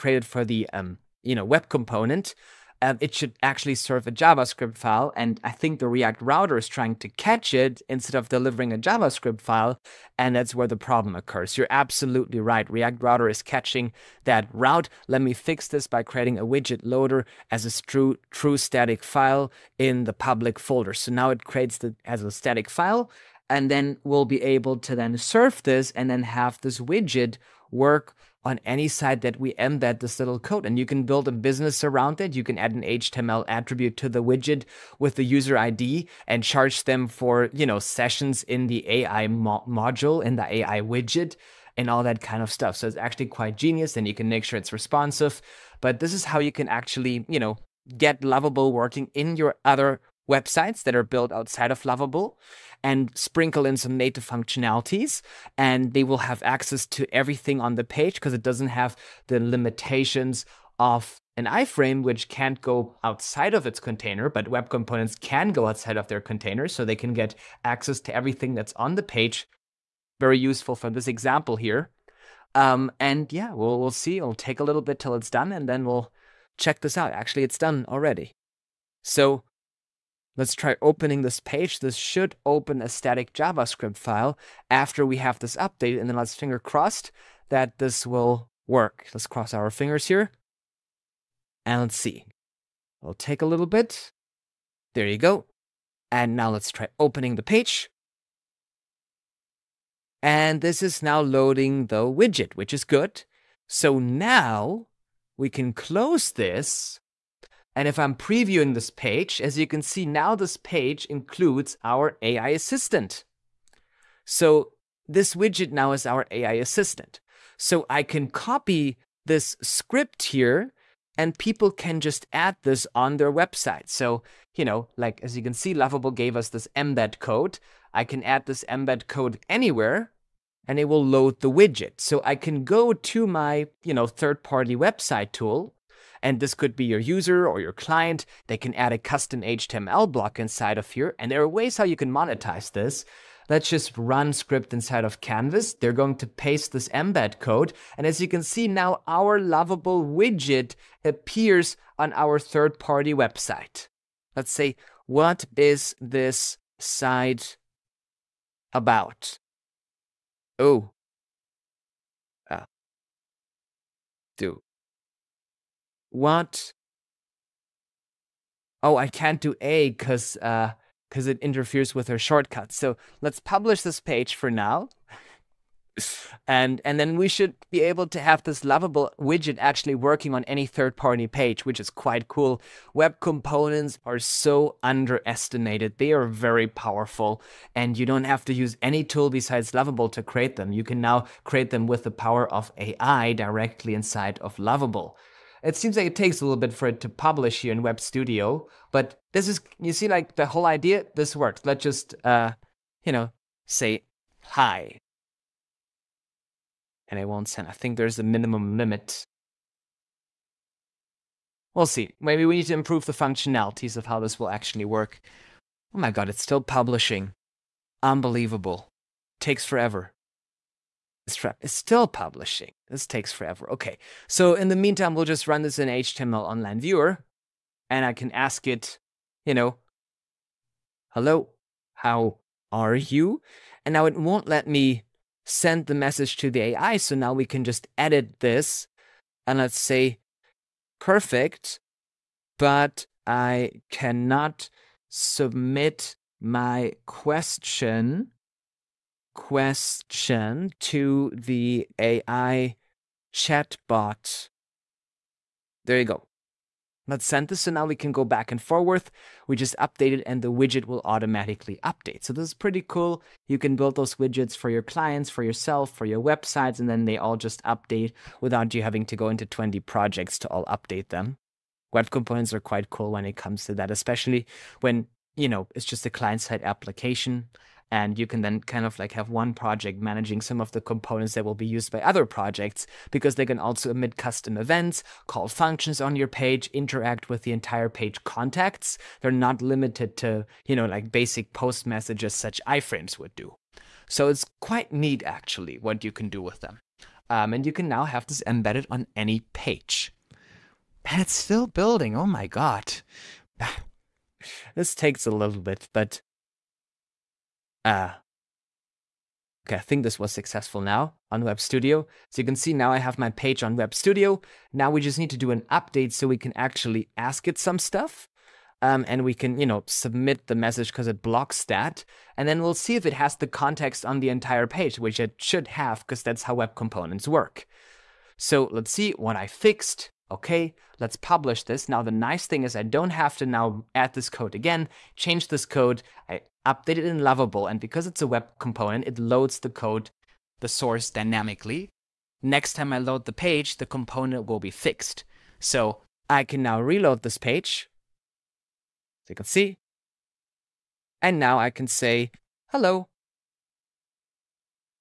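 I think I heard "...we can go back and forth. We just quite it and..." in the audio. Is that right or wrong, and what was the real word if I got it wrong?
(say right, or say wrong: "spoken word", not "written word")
wrong: "update", not "quite".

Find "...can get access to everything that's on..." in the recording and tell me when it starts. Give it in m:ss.
1:06.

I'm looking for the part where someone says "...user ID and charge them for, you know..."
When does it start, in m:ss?
0:35.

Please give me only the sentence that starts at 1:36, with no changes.
And now let's try opening the page.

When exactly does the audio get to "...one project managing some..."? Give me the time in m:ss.
4:39.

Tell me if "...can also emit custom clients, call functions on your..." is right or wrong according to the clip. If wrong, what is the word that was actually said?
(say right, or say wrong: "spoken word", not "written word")
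wrong: "events", not "clients".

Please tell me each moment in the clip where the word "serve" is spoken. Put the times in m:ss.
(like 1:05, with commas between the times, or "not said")
0:03, 0:25.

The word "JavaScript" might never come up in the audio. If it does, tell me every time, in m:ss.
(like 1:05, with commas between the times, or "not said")
0:04, 0:08, 1:23.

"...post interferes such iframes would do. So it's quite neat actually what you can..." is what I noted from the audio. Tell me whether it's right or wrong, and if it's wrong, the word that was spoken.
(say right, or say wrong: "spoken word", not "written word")
wrong: "messages", not "interferes".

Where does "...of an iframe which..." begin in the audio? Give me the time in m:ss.
1:00.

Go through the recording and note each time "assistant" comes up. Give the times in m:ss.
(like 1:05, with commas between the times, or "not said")
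1:52, 1:56.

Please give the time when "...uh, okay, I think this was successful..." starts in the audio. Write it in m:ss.
5:07.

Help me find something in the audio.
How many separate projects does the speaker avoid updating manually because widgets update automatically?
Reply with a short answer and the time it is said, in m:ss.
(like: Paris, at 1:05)
20, at 4:29.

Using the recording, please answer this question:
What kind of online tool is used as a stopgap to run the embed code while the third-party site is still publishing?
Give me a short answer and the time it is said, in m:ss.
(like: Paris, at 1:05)
HTML online viewer, at 3:45.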